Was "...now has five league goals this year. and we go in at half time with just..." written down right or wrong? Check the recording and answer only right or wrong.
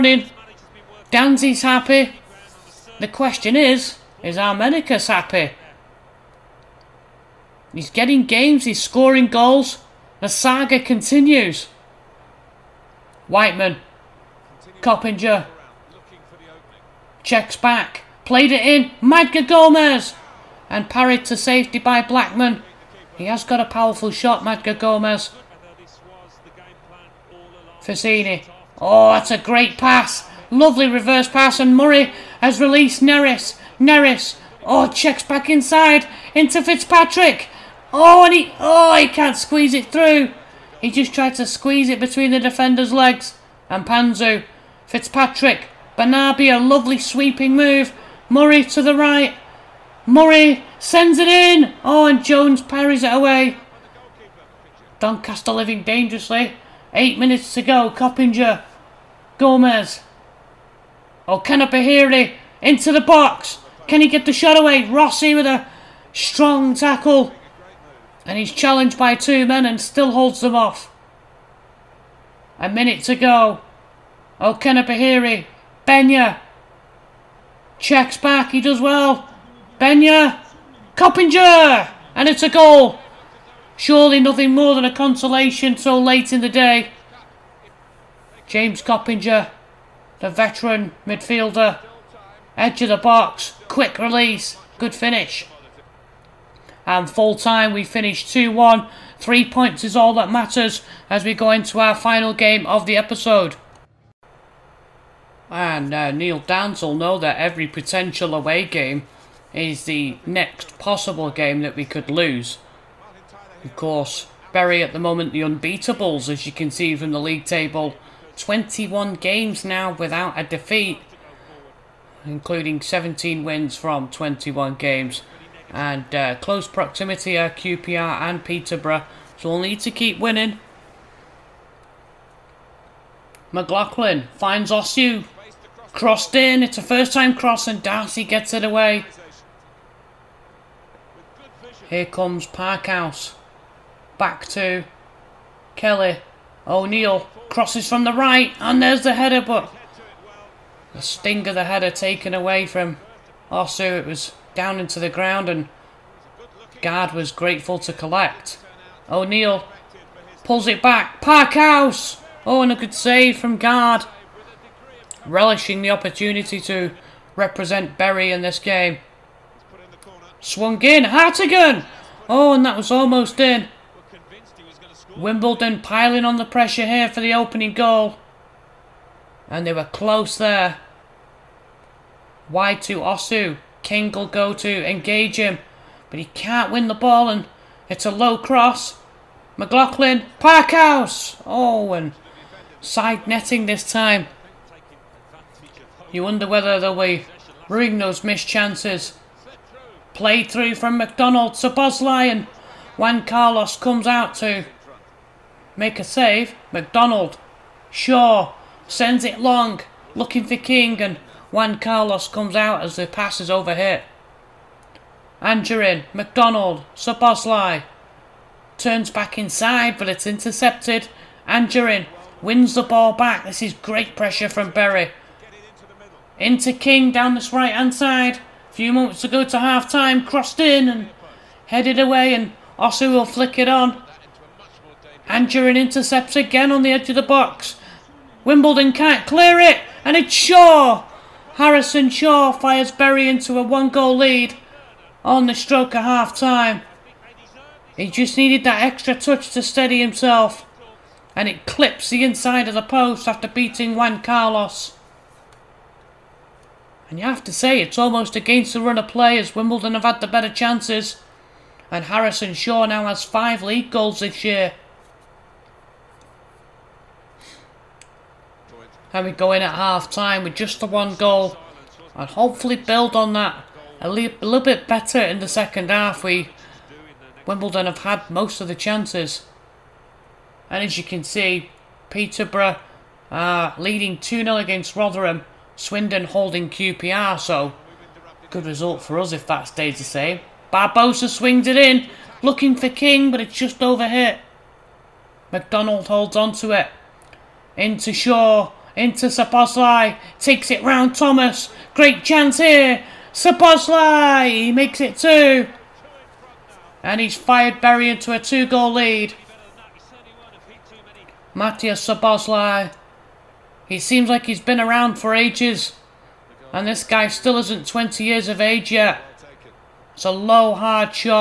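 right.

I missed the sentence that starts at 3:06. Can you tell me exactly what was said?
But he can't win the ball and it's a low cross.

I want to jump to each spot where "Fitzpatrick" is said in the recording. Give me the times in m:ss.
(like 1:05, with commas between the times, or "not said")
0:36, 0:44.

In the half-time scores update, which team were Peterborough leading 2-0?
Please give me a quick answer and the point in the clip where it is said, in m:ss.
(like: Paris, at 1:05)
Rotherham, at 4:44.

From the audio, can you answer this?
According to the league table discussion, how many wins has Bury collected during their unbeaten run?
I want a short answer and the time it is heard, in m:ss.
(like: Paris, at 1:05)
17, at 2:02.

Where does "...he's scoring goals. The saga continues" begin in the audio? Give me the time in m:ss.
0:08.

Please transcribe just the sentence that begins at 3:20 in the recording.
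Play through from McDonald to Bosley and Juan Carlos comes out to Make a save.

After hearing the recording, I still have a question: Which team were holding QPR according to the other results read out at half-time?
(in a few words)
Swindon.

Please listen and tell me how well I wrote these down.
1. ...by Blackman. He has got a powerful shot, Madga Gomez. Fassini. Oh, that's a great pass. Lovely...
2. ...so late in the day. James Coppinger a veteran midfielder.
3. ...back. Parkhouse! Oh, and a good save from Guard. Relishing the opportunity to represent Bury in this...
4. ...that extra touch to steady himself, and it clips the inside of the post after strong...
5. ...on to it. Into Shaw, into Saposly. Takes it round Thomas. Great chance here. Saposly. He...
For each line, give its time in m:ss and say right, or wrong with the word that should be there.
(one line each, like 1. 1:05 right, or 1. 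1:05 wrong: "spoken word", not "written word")
1. 0:21 right
2. 1:25 right
3. 2:40 right
4. 4:08 wrong: "beating", not "strong"
5. 4:56 right.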